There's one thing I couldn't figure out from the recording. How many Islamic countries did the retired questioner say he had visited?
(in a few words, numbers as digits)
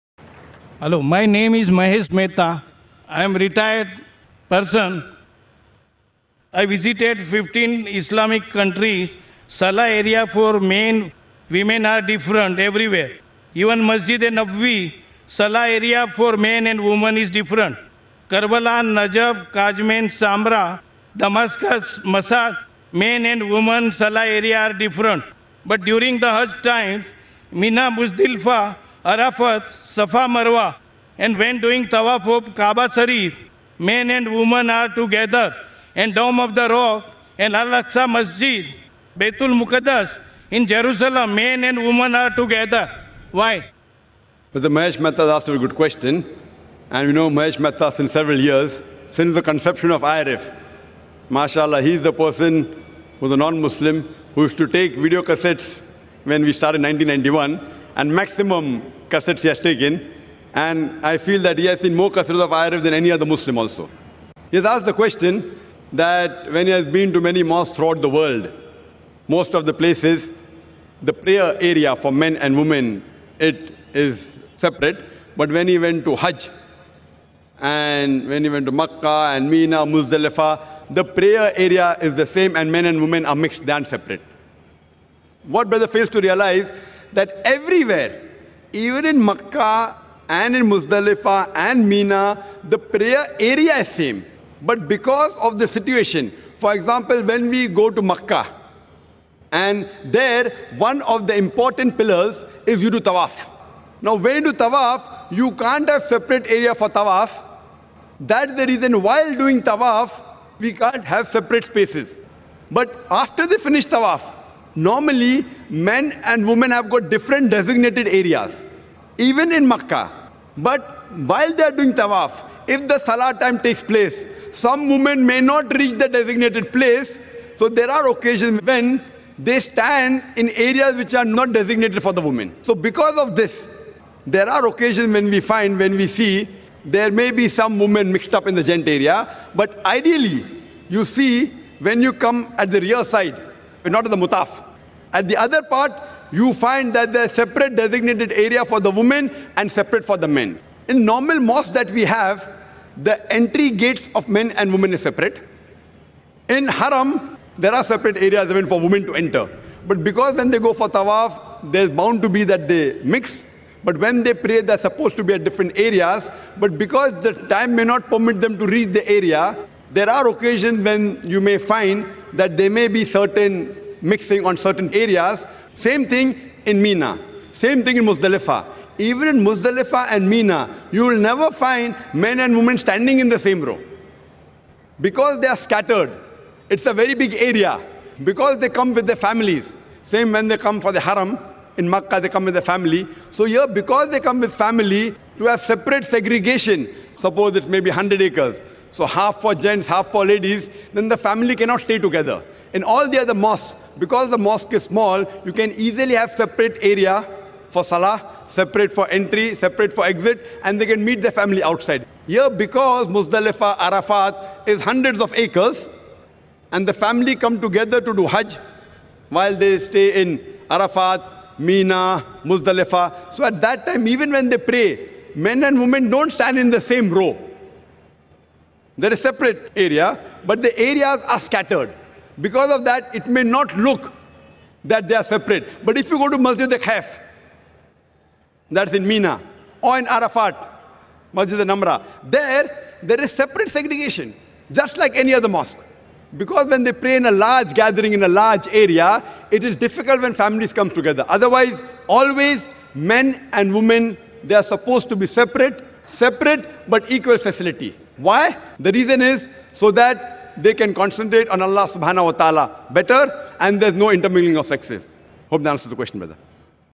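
15.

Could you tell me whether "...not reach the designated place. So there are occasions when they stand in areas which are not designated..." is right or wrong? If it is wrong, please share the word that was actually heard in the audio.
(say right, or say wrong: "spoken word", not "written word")
right.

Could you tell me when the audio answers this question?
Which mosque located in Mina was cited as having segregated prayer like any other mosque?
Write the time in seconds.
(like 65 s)
236 s.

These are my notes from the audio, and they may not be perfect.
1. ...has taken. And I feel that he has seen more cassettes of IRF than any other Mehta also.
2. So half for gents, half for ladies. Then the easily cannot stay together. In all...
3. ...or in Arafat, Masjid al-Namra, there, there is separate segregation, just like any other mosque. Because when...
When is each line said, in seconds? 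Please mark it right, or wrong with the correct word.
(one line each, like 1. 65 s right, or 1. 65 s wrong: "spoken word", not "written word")
1. 59 s wrong: "Muslim", not "Mehta"
2. 198 s wrong: "family", not "easily"
3. 239 s right.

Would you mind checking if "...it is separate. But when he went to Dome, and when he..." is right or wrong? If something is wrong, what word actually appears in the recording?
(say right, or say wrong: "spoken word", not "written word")
wrong: "Hajj", not "Dome".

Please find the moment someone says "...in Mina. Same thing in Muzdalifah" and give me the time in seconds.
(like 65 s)
176 s.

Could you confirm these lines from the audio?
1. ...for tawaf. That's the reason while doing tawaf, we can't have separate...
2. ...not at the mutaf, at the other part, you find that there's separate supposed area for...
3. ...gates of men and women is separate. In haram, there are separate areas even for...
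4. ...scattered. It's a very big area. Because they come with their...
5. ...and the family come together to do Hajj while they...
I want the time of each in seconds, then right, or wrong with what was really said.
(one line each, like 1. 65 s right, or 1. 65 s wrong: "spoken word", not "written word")
1. 106 s right
2. 143 s wrong: "designated", not "supposed"
3. 153 s right
4. 185 s right
5. 216 s right.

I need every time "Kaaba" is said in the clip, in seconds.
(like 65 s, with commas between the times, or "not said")
32 s.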